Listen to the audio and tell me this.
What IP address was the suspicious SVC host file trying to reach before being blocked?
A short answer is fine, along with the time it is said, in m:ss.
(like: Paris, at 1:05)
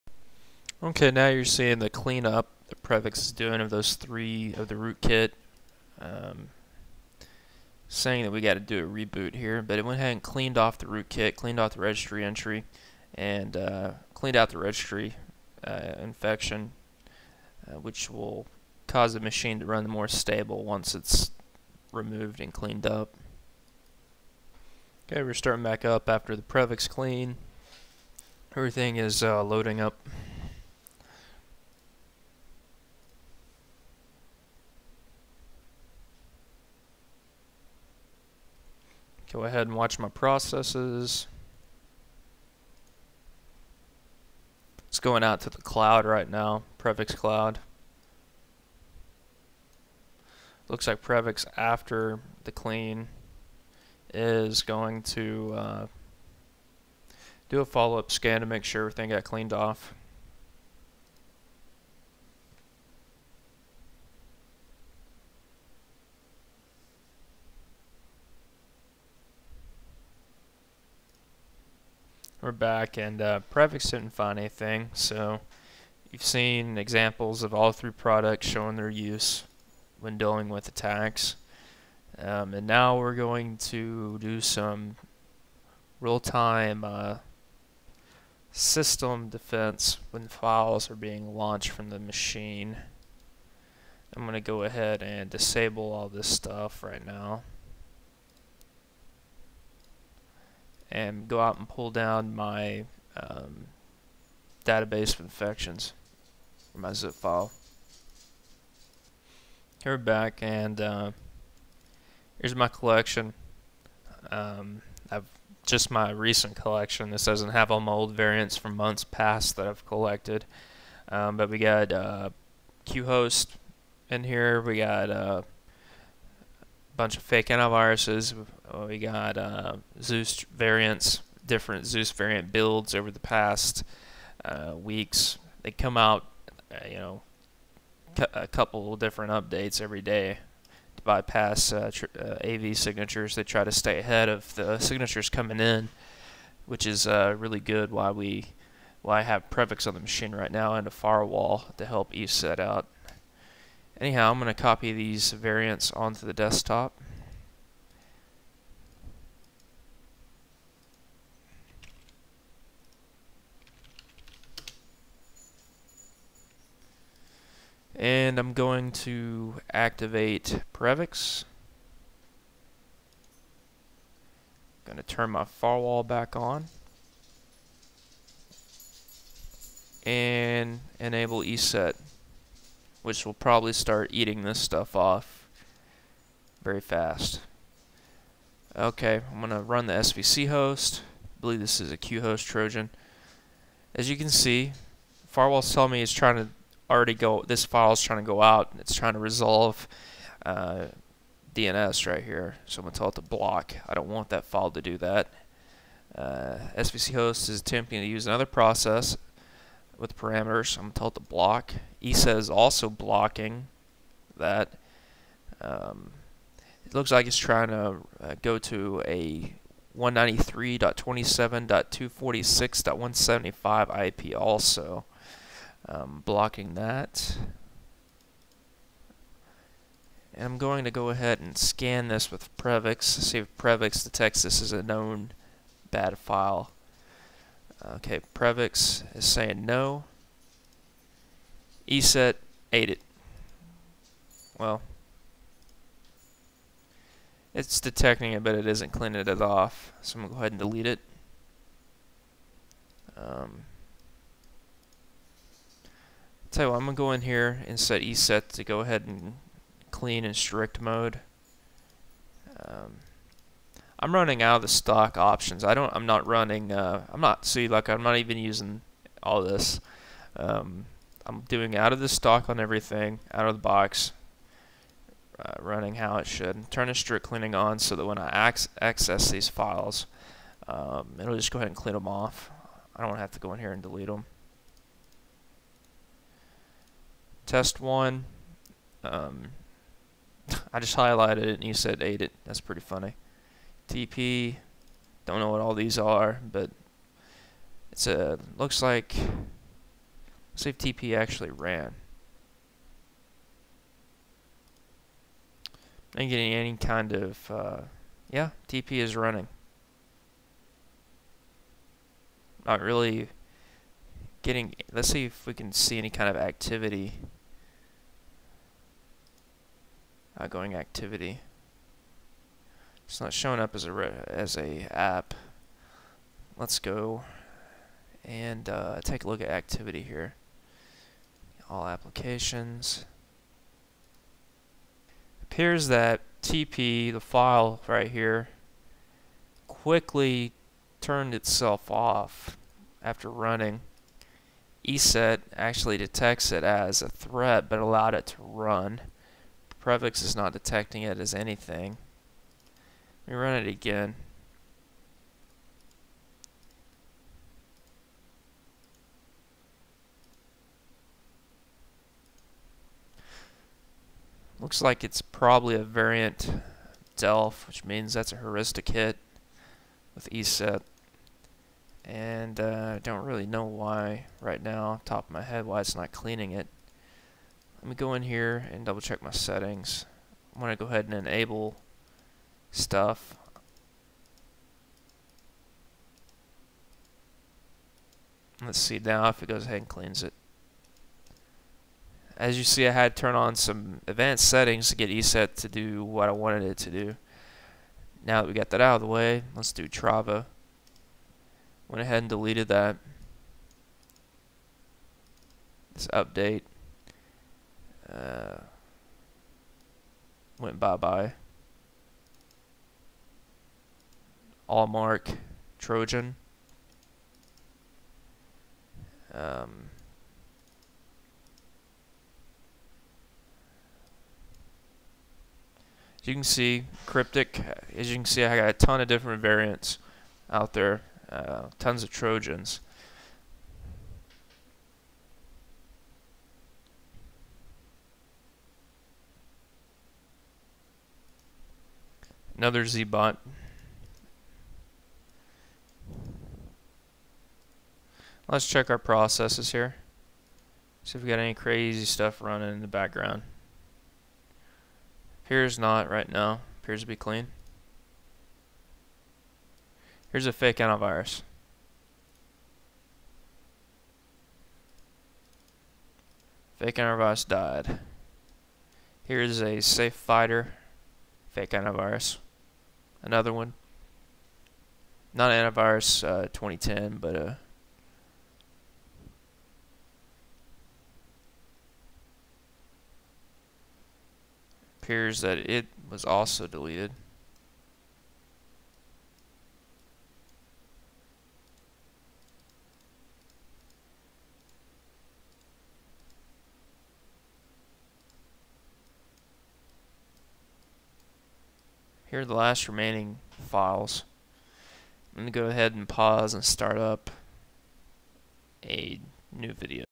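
193.27.246.175, at 3:39.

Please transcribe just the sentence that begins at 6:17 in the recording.
Let me go in here and double check my settings.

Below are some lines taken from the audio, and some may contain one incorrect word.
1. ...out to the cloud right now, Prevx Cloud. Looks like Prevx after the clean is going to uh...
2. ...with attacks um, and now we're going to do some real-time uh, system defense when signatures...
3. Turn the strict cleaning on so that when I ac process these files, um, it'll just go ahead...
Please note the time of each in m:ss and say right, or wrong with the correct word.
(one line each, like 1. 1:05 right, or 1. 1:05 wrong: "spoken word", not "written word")
1. 0:45 right
2. 1:20 wrong: "files", not "signatures"
3. 4:36 wrong: "access", not "process".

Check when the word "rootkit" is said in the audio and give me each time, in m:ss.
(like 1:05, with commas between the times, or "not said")
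0:04, 0:10.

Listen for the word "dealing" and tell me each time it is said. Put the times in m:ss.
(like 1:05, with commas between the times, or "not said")
1:20.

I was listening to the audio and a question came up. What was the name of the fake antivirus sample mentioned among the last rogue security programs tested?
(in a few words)
Safe Fighter.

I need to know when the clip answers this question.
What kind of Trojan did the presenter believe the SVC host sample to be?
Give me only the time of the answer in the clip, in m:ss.
3:11.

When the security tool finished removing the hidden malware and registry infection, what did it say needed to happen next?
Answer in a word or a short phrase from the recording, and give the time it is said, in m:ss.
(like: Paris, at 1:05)
a reboot, at 0:08.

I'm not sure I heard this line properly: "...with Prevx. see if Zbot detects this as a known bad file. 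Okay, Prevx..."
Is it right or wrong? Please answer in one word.
wrong.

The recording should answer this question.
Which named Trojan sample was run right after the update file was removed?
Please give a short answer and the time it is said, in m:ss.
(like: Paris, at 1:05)
Allmark, at 6:54.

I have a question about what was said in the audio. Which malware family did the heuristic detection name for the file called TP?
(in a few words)
Delf.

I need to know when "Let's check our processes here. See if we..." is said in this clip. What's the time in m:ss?
7:28.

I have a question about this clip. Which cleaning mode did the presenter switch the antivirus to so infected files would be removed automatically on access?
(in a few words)
strict mode.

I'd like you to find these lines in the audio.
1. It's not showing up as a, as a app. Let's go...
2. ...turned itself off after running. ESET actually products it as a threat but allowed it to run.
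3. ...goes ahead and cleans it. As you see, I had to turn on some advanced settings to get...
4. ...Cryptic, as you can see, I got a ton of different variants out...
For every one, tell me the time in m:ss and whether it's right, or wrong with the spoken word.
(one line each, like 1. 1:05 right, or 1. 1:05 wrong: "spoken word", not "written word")
1. 5:23 right
2. 5:40 wrong: "detects", not "products"
3. 6:29 right
4. 7:07 right.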